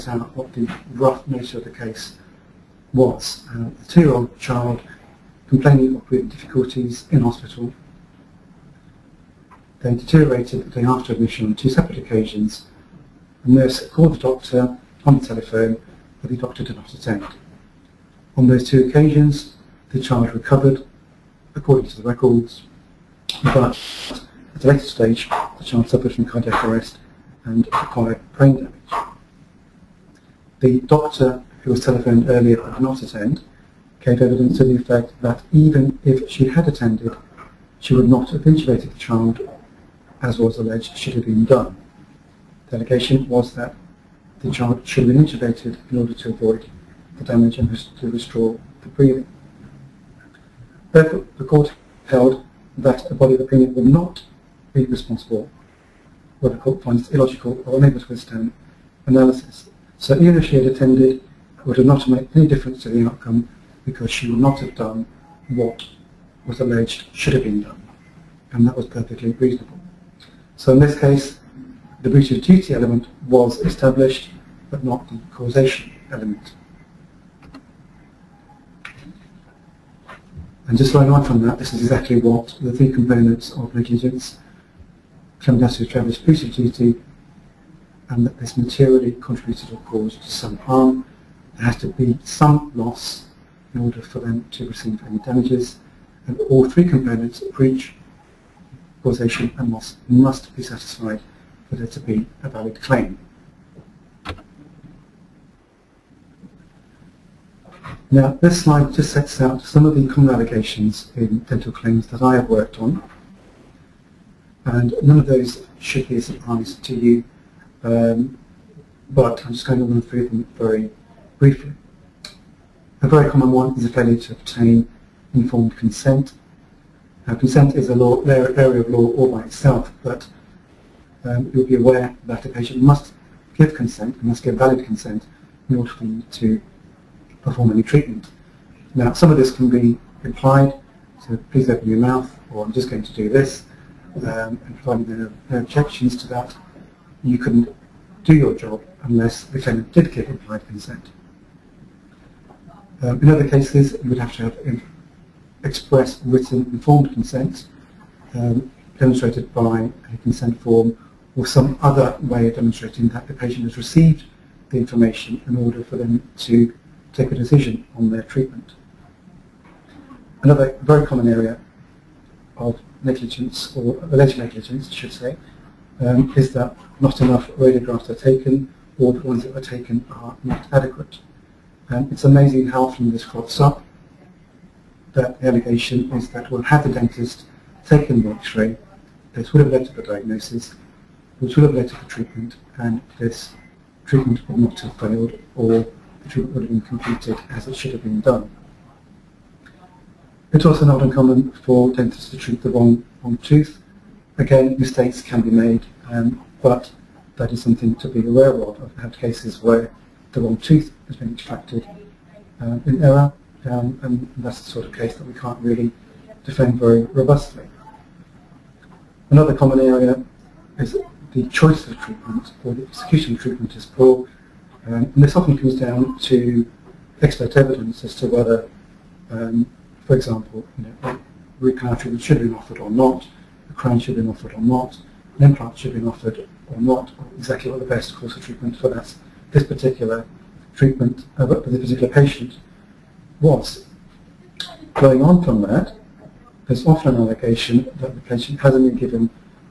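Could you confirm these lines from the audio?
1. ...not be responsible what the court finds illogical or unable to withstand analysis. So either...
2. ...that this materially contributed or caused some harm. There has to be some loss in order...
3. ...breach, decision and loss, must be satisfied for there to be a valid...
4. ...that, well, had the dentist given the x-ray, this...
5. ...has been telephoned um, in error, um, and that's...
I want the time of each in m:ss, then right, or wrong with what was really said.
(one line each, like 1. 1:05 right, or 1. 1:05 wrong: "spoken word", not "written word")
1. 0:53 right
2. 1:28 right
3. 1:37 wrong: "causation", not "decision"
4. 3:06 wrong: "taken", not "given"
5. 3:31 wrong: "extracted", not "telephoned".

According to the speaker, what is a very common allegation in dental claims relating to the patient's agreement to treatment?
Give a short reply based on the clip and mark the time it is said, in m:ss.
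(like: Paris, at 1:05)
Failure to obtain informed consent, at 2:03.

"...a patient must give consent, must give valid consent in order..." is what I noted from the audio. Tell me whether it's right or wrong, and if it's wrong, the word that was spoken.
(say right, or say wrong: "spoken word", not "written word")
right.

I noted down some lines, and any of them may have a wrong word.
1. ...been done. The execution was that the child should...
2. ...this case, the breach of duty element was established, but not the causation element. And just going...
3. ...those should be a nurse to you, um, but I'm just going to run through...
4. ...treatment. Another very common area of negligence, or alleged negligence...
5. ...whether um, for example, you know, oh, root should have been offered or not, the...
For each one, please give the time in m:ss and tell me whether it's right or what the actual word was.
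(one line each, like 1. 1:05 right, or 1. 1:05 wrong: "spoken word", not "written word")
1. 0:41 wrong: "allegation", not "execution"
2. 1:10 right
3. 1:55 wrong: "surprise", not "nurse"
4. 2:48 right
5. 3:48 right.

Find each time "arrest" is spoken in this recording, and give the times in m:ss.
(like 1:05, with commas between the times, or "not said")
0:26.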